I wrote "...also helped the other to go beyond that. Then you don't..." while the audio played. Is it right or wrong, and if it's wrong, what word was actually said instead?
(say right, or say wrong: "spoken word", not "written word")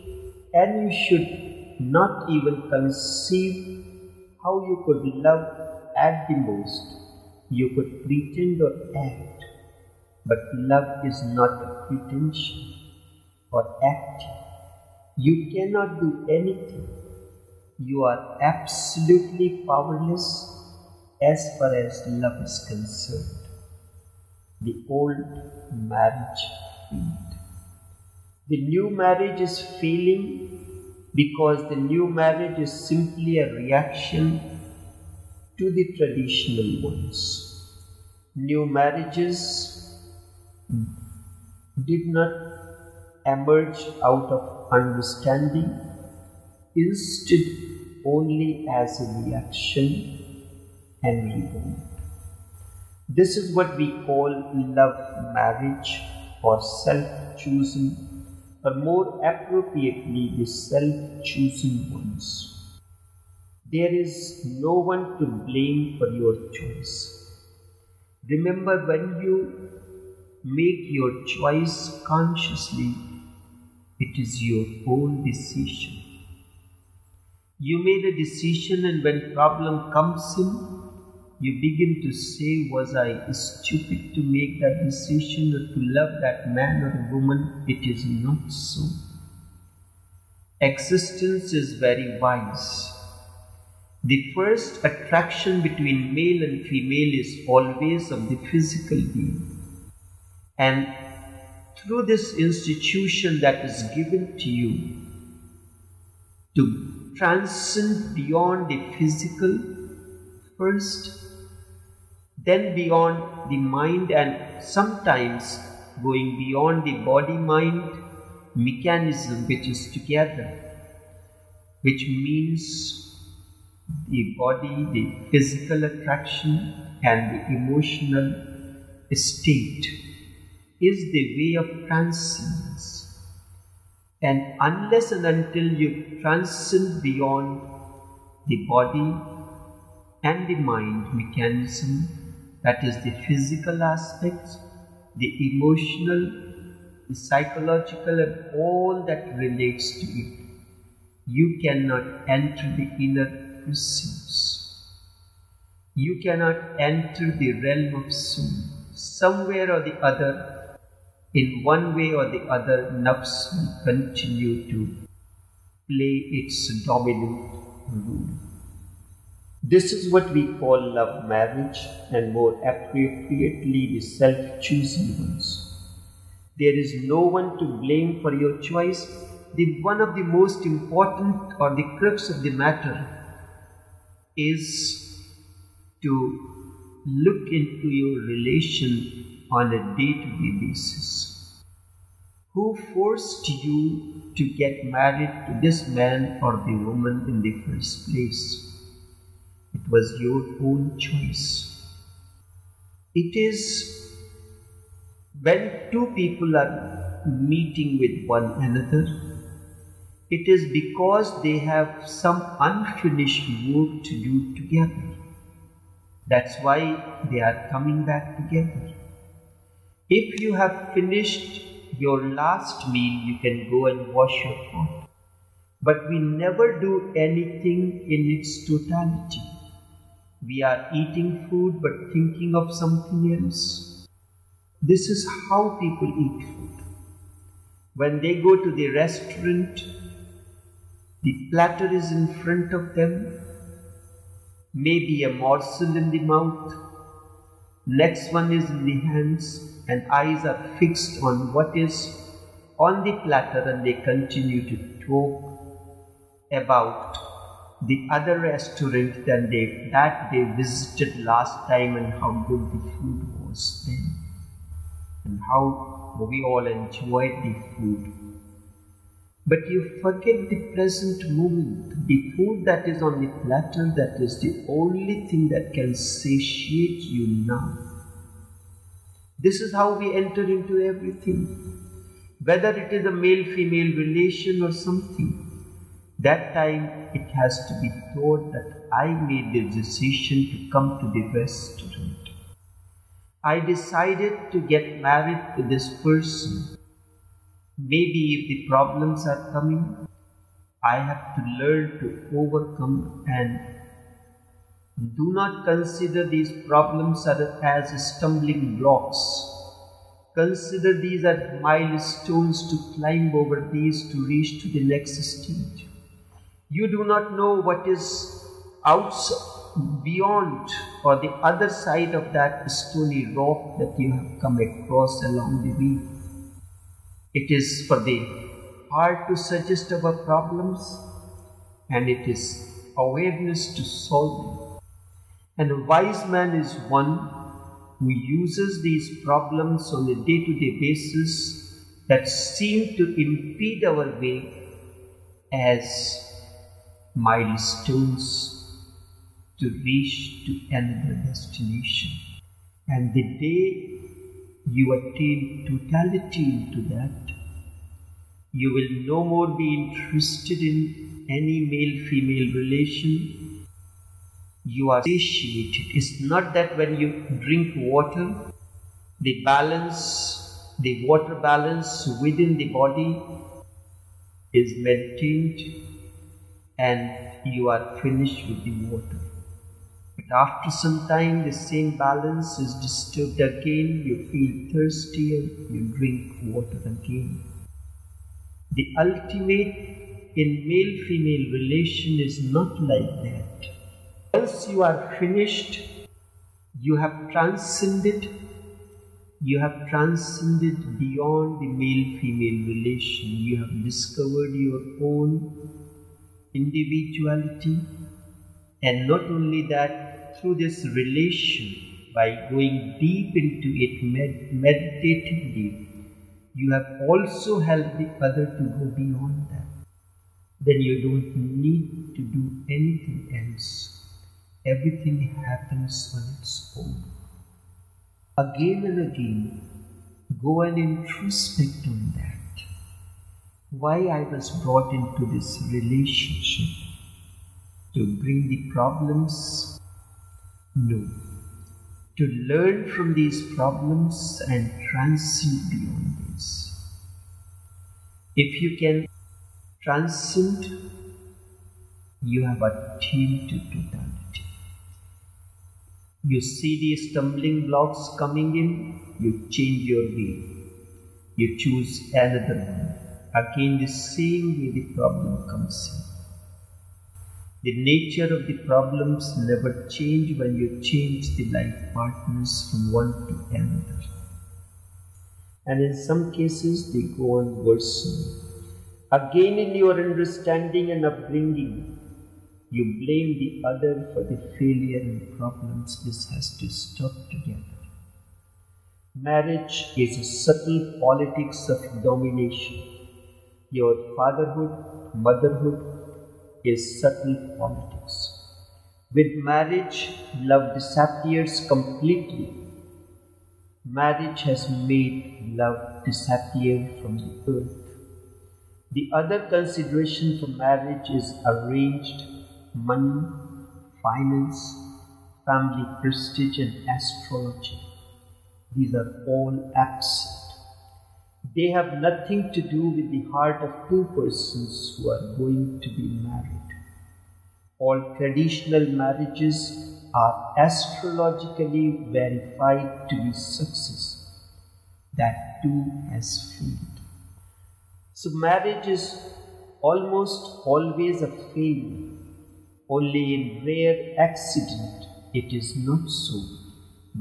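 right.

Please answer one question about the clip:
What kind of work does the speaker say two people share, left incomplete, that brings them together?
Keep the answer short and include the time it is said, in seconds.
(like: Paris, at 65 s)
unfinished work, at 212 s.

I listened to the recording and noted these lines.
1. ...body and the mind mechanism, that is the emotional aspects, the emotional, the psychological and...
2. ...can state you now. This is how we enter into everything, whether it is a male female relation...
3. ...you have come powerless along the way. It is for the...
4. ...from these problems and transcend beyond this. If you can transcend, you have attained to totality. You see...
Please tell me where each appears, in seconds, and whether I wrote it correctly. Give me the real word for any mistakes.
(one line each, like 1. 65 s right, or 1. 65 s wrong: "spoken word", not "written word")
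1. 138 s wrong: "physical", not "emotional"
2. 275 s wrong: "satiate", not "state"
3. 323 s wrong: "across", not "powerless"
4. 442 s right.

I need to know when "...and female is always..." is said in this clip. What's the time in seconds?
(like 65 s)
96 s.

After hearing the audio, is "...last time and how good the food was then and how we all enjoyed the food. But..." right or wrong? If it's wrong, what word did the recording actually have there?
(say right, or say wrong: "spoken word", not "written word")
right.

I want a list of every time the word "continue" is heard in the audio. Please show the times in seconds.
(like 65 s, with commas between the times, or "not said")
163 s, 253 s.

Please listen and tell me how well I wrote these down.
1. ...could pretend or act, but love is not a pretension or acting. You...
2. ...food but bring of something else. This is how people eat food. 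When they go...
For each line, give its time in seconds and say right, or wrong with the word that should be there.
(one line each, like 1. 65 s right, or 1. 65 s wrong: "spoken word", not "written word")
1. 7 s right
2. 231 s wrong: "thinking", not "bring".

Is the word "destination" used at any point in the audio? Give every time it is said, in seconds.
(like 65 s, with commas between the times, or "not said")
351 s.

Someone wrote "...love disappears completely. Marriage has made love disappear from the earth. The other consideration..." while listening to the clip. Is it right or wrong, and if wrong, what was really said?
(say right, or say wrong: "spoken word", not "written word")
right.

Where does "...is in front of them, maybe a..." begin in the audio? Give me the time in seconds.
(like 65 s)
241 s.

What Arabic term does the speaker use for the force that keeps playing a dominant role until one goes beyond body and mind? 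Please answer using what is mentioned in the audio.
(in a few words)
nafs.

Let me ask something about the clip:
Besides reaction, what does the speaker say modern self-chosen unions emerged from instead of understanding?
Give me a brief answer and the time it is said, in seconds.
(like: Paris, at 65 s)
rebound, at 51 s.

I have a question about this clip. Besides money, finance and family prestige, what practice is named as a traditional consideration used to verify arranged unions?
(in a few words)
astrology.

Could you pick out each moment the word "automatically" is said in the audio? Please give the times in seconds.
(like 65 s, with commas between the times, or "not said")
not said.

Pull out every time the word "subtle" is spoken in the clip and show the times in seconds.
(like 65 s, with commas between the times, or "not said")
490 s, 497 s.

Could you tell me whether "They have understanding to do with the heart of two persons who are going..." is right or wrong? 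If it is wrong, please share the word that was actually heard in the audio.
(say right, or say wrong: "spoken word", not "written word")
wrong: "nothing", not "understanding".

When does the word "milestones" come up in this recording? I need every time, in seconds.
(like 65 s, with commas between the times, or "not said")
311 s, 347 s.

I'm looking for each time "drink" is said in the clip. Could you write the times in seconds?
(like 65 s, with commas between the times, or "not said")
367 s, 385 s.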